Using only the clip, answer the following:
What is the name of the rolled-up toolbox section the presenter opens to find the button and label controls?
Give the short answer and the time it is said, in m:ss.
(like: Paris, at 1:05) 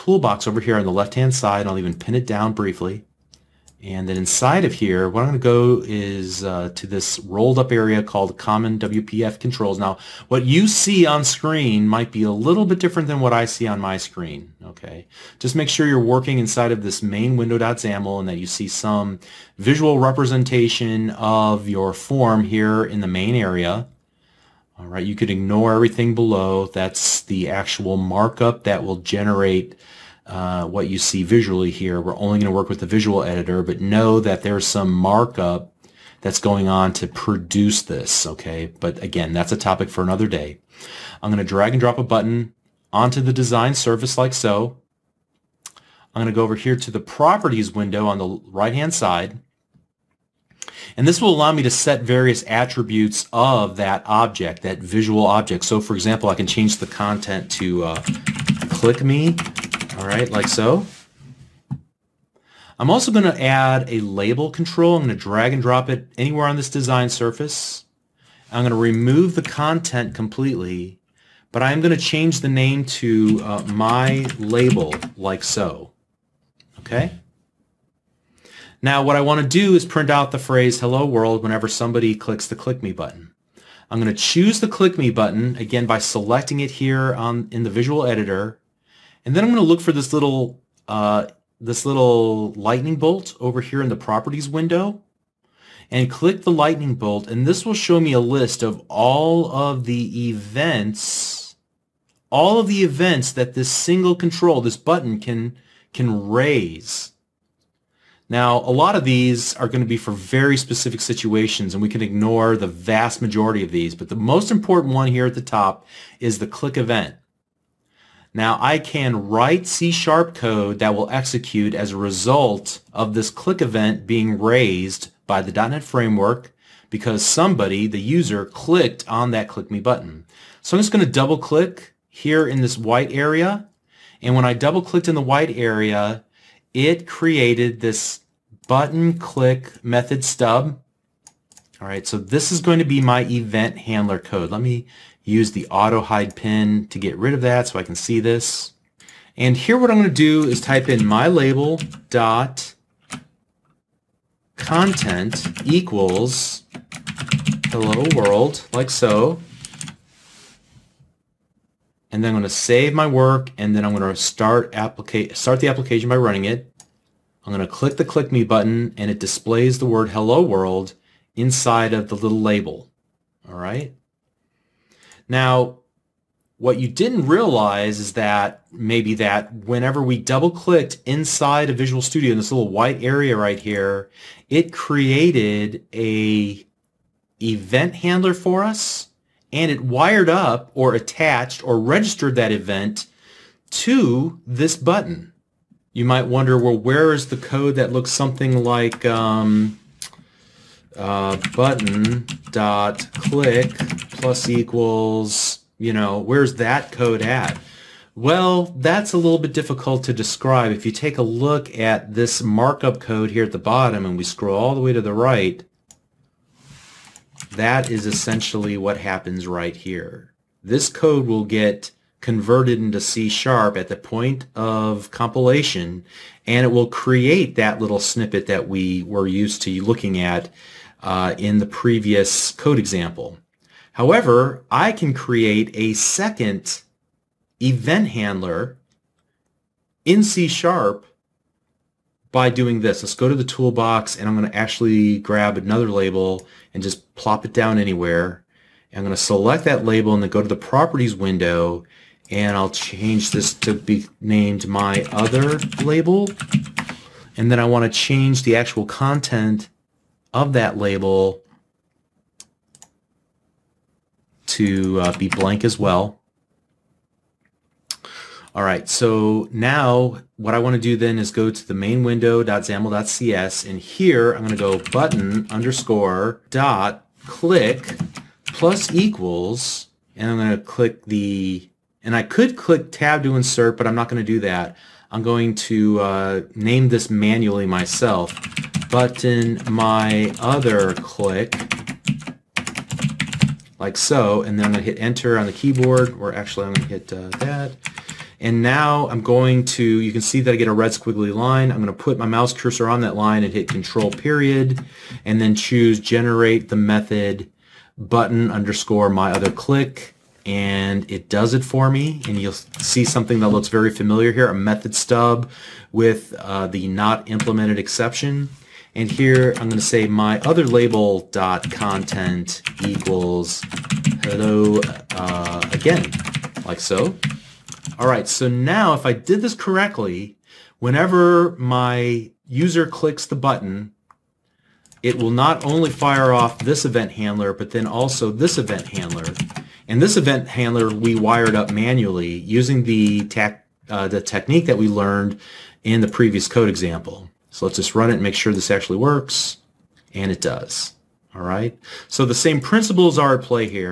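Common WPF Controls, at 0:08.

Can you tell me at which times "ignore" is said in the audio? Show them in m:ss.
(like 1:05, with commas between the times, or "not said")
0:25, 1:52.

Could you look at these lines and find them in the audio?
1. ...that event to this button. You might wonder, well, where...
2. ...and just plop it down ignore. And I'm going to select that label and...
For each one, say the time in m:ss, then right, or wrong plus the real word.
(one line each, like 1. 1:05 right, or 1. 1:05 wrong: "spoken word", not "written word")
1. 3:12 right
2. 4:06 wrong: "anywhere", not "ignore".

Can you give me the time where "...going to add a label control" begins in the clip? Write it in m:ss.
1:03.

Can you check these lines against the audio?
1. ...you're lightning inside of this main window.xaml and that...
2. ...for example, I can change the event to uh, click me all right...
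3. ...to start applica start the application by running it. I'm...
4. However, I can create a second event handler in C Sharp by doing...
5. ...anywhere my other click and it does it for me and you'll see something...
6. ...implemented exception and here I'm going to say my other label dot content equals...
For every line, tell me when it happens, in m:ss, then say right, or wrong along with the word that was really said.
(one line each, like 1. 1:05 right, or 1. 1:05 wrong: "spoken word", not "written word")
1. 0:15 wrong: "working", not "lightning"
2. 0:55 wrong: "content", not "event"
3. 2:44 right
4. 3:53 right
5. 5:08 wrong: "underscore", not "anywhere"
6. 5:17 right.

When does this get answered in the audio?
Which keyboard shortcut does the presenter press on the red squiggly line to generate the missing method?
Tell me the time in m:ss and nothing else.
5:03.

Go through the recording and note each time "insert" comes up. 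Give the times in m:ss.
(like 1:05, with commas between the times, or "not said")
4:43.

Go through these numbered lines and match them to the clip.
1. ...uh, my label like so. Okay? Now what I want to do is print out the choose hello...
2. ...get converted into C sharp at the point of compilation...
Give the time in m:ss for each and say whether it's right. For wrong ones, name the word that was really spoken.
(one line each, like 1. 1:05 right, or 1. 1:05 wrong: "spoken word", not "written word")
1. 1:13 wrong: "phrase", not "choose"
2. 3:41 right.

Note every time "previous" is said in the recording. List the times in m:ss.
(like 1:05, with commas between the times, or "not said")
3:51, 5:46.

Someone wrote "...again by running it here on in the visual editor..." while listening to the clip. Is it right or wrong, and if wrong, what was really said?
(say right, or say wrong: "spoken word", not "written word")
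wrong: "selecting", not "running".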